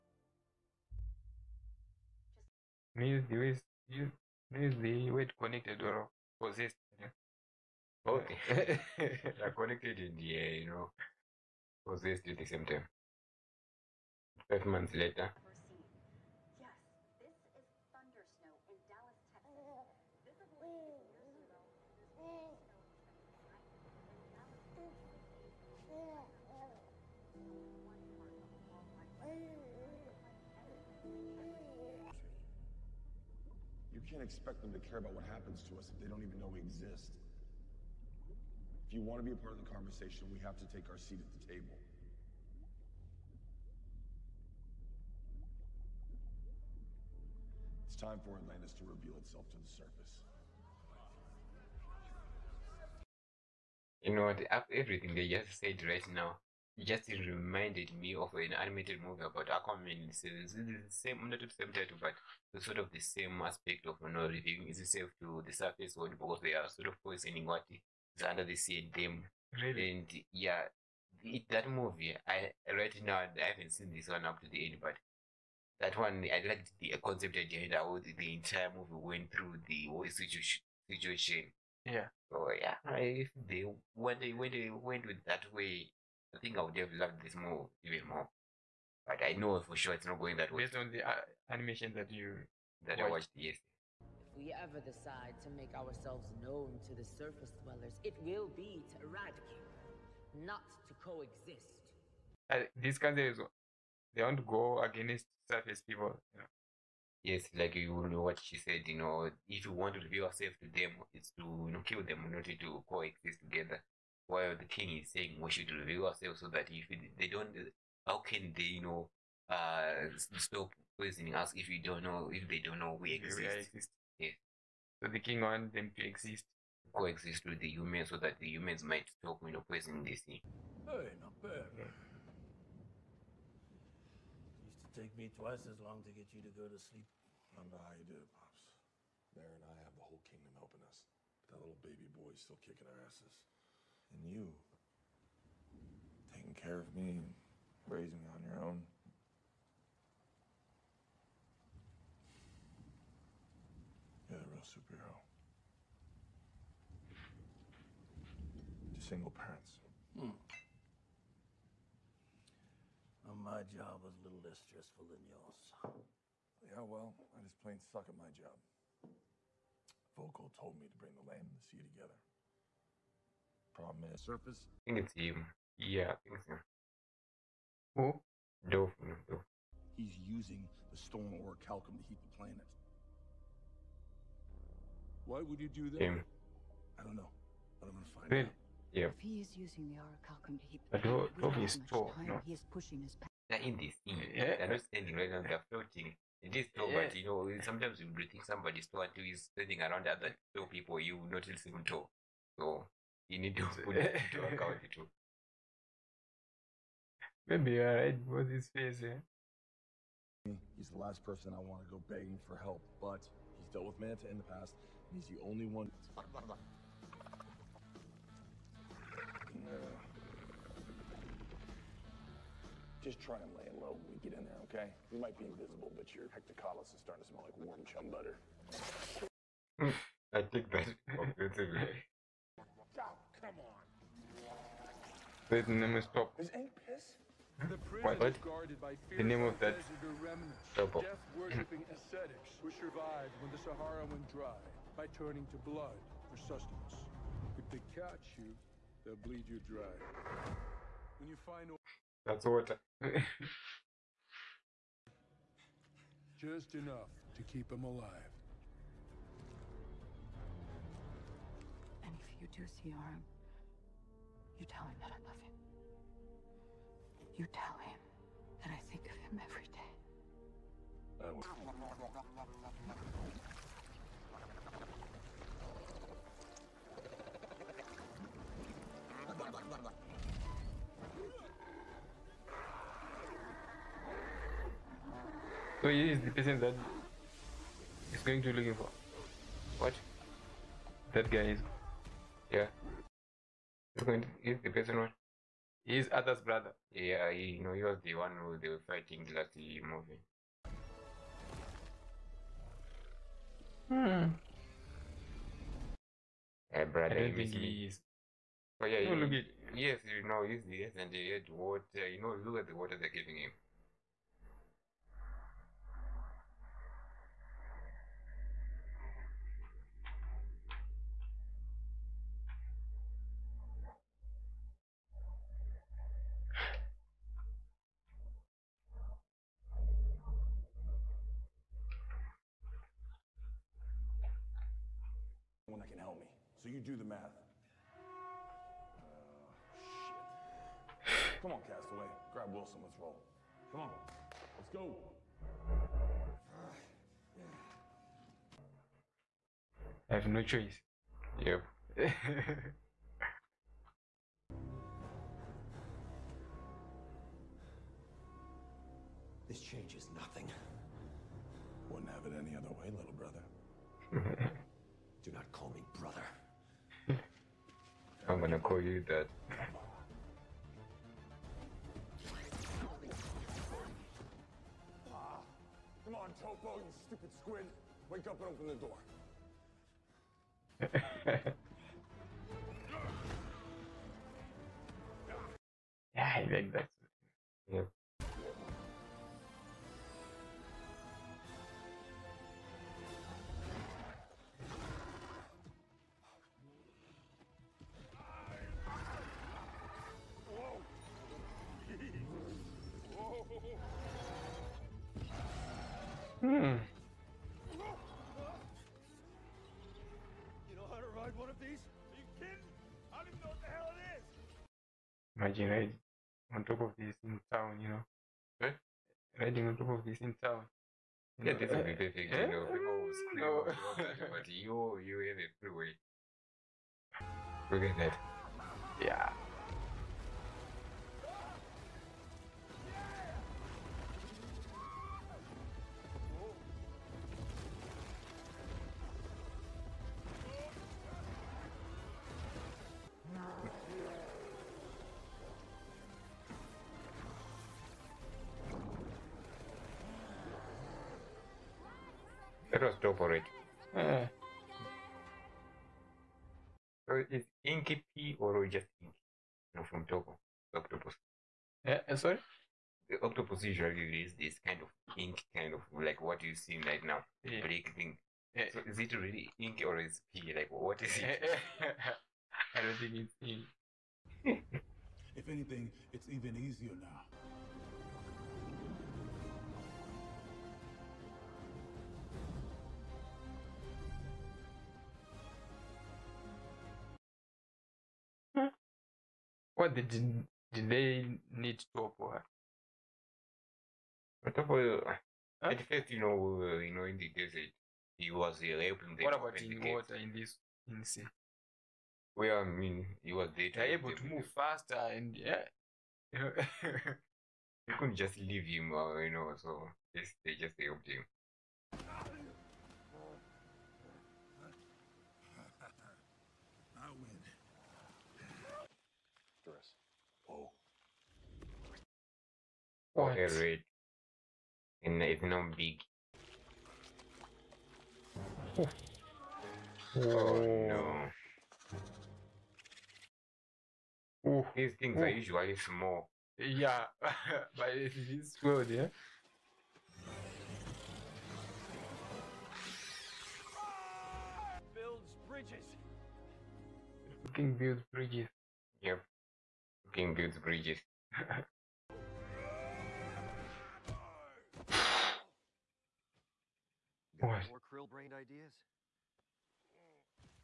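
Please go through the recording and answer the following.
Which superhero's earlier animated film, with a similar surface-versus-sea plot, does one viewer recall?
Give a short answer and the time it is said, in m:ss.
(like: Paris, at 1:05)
Aquaman, at 0:59.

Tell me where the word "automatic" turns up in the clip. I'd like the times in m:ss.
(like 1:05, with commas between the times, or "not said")
not said.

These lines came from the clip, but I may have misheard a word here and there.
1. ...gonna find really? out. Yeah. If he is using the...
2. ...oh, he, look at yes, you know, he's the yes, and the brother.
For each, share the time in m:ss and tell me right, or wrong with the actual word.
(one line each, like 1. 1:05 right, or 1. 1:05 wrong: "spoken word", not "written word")
1. 3:07 right
2. 5:09 wrong: "water", not "brother".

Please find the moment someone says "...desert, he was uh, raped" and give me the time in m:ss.
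8:17.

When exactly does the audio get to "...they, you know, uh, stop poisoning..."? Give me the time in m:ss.
1:58.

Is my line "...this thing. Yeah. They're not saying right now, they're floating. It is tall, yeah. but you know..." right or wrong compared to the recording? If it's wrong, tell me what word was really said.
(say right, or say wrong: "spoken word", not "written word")
wrong: "standing", not "saying".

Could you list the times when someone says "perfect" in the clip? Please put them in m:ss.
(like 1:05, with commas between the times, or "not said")
7:01.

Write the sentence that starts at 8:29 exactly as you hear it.
So just, they just helped him.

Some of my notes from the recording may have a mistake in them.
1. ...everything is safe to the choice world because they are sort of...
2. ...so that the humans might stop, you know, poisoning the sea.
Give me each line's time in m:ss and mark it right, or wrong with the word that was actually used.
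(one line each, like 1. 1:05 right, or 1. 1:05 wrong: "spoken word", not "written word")
1. 1:04 wrong: "surface", not "choice"
2. 2:08 right.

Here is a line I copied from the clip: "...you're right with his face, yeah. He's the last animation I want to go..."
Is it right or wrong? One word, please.
wrong.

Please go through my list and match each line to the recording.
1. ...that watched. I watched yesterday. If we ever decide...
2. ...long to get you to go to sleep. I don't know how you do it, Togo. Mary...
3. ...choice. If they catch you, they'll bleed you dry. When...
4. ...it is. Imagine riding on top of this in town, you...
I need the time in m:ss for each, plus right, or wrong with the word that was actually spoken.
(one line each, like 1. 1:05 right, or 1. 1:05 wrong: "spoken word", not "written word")
1. 1:32 right
2. 2:15 wrong: "Pops", not "Togo"
3. 4:06 wrong: "sustenance", not "choice"
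4. 6:53 right.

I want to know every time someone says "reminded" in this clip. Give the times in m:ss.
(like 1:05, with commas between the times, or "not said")
0:57.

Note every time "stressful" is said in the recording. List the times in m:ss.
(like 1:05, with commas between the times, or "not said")
2:44.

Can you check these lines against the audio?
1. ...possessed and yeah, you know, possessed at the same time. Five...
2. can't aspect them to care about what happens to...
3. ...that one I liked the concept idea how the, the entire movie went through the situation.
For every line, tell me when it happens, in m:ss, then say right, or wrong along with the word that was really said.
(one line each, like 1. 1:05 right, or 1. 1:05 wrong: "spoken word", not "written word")
1. 0:09 wrong: "connected", not "possessed"
2. 0:34 wrong: "expect", not "aspect"
3. 1:15 right.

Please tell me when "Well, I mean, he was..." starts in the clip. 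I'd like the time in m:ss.
8:22.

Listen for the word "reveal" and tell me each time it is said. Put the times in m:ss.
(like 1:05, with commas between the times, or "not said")
0:48, 1:50.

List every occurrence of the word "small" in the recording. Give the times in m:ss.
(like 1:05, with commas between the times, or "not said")
8:55.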